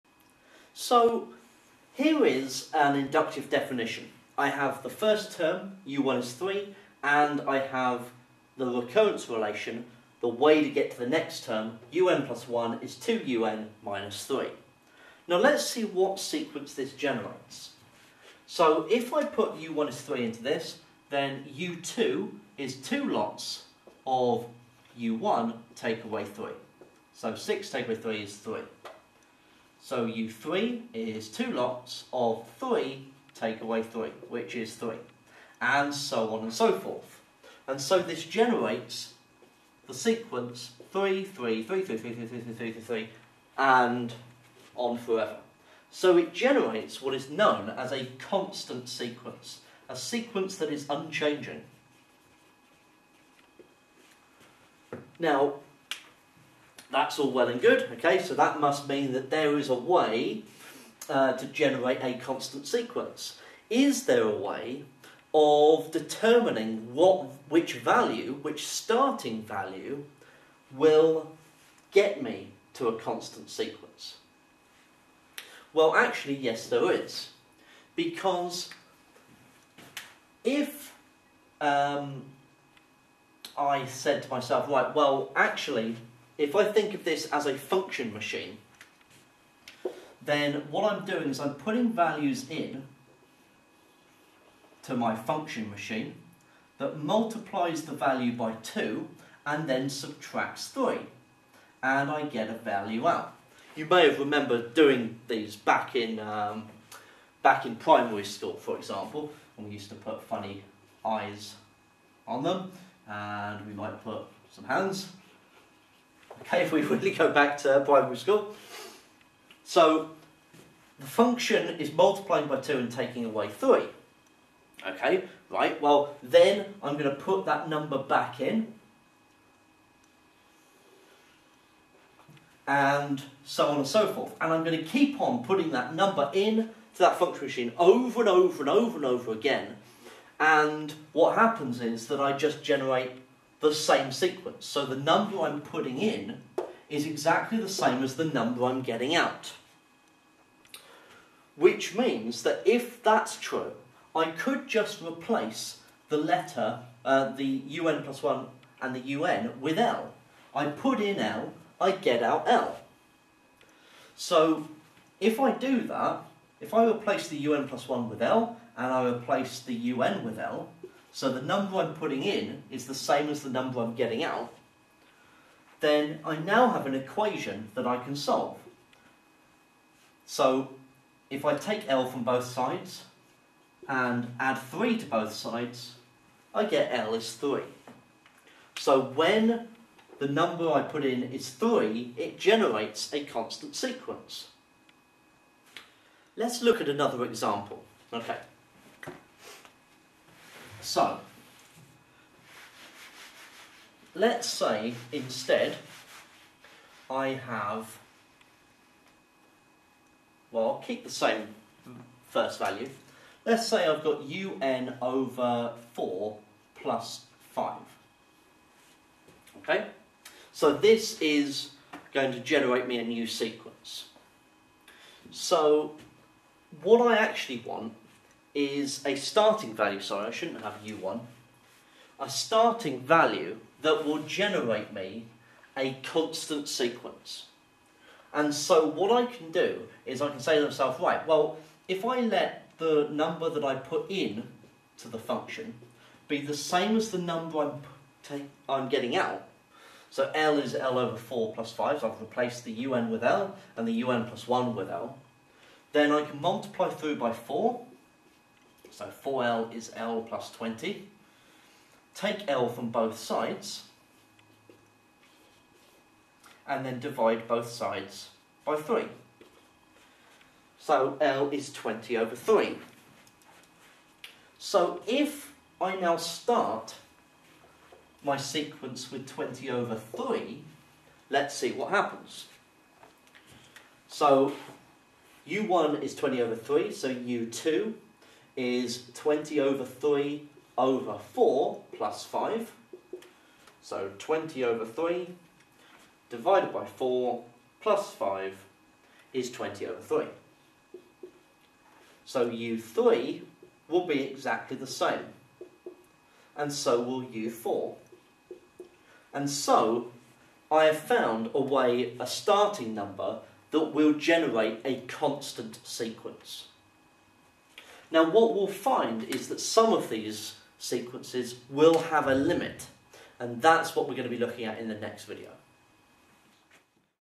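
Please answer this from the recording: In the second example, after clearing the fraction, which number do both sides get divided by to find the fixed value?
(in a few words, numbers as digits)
3.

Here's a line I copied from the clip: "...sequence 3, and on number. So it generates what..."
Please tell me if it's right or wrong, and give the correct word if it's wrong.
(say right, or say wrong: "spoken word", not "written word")
wrong: "forever", not "number".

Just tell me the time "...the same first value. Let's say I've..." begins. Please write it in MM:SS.
03:31.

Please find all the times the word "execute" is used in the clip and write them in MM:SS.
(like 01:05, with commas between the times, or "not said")
not said.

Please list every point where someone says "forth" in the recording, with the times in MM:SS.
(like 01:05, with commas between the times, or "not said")
00:36, 02:14.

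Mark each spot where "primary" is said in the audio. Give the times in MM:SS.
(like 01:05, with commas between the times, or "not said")
01:47, 01:57.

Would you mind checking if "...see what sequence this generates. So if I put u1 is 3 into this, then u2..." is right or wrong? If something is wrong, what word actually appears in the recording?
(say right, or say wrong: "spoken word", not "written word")
right.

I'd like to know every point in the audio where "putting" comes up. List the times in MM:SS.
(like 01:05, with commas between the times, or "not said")
01:31, 02:15, 02:25, 02:51.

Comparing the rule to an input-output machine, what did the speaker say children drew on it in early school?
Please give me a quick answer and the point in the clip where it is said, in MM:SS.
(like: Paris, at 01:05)
funny eyes, at 01:50.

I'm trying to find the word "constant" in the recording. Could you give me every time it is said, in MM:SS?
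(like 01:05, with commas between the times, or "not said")
00:48, 01:02, 01:12, 03:13, 03:56, 05:15.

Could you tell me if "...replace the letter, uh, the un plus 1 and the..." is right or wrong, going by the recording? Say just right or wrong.
right.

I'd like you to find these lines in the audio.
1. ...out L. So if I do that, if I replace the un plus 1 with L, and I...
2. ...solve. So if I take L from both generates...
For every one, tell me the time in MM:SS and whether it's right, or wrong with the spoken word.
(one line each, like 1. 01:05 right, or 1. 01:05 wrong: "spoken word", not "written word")
1. 02:42 right
2. 02:58 wrong: "sides", not "generates".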